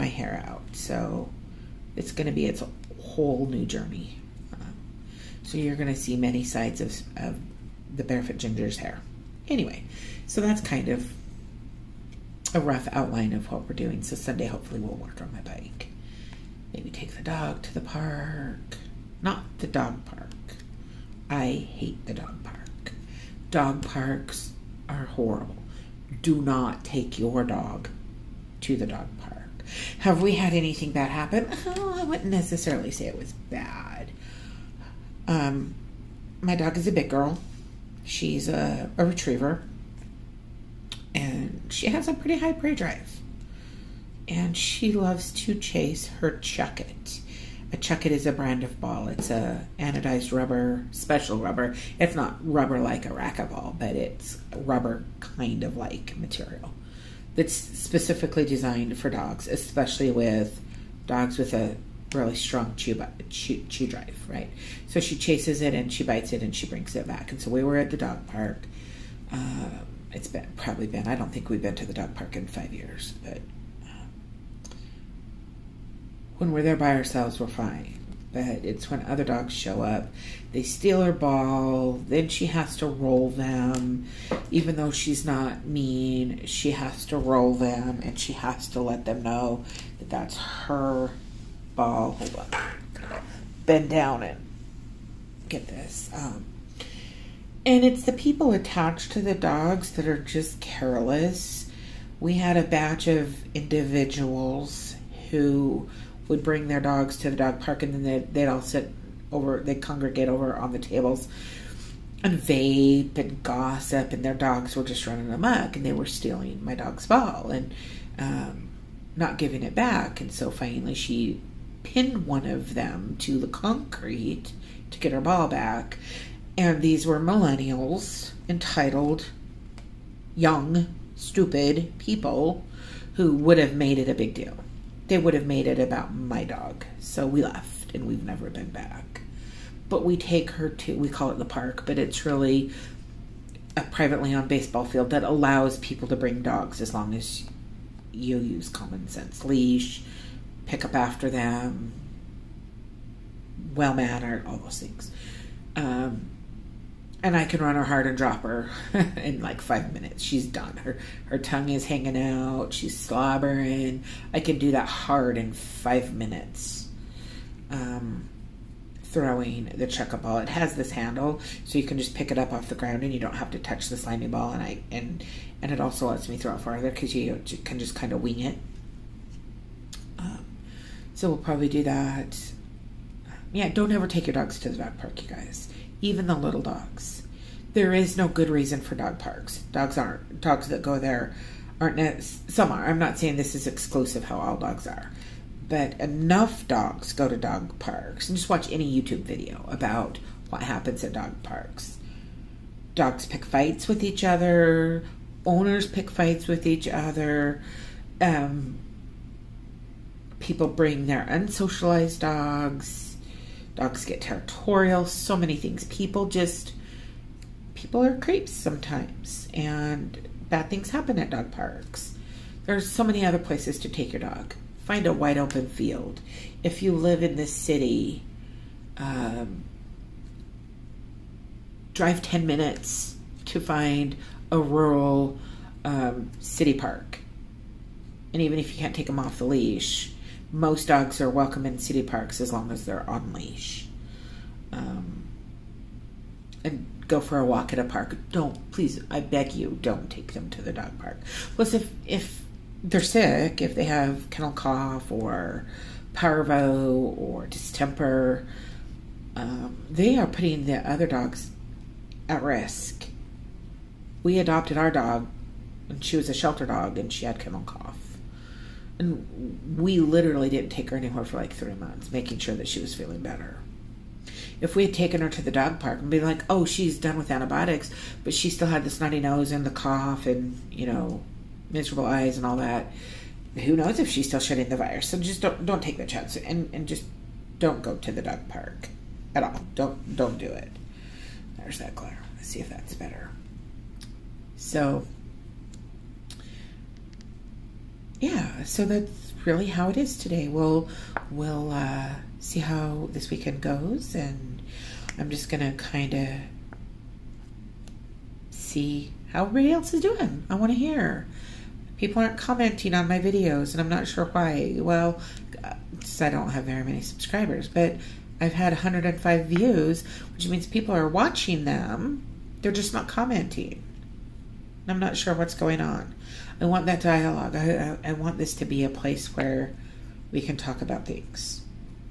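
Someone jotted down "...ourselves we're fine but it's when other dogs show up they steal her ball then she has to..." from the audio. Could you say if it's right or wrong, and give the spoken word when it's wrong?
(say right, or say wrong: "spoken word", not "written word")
right.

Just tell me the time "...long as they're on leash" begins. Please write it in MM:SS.
04:02.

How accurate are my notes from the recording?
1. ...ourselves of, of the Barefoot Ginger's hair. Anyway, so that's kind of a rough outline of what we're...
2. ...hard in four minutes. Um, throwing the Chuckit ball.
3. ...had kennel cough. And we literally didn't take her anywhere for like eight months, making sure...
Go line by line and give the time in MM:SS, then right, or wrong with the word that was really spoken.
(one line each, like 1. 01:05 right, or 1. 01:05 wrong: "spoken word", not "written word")
1. 00:06 wrong: "sides", not "ourselves"
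2. 02:44 wrong: "five", not "four"
3. 04:27 wrong: "three", not "eight".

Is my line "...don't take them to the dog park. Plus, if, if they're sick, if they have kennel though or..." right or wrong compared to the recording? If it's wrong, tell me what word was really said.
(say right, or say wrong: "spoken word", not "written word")
wrong: "cough", not "though".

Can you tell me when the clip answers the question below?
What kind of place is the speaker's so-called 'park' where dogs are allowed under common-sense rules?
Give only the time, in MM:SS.
02:24.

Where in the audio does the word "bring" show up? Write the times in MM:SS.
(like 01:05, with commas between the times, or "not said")
01:06, 01:46, 02:26, 03:30.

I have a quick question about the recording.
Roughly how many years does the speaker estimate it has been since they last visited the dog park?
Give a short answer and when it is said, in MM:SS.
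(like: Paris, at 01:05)
5, at 01:12.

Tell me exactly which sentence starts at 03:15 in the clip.
But enough dogs go to dog parks.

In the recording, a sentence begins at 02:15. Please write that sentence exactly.
They would have made it about my dog.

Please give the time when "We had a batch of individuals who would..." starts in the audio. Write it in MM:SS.
01:42.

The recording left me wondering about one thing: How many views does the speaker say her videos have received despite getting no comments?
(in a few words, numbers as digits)
105.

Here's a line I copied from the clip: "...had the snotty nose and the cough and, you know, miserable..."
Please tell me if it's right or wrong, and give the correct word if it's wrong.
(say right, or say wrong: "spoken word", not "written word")
right.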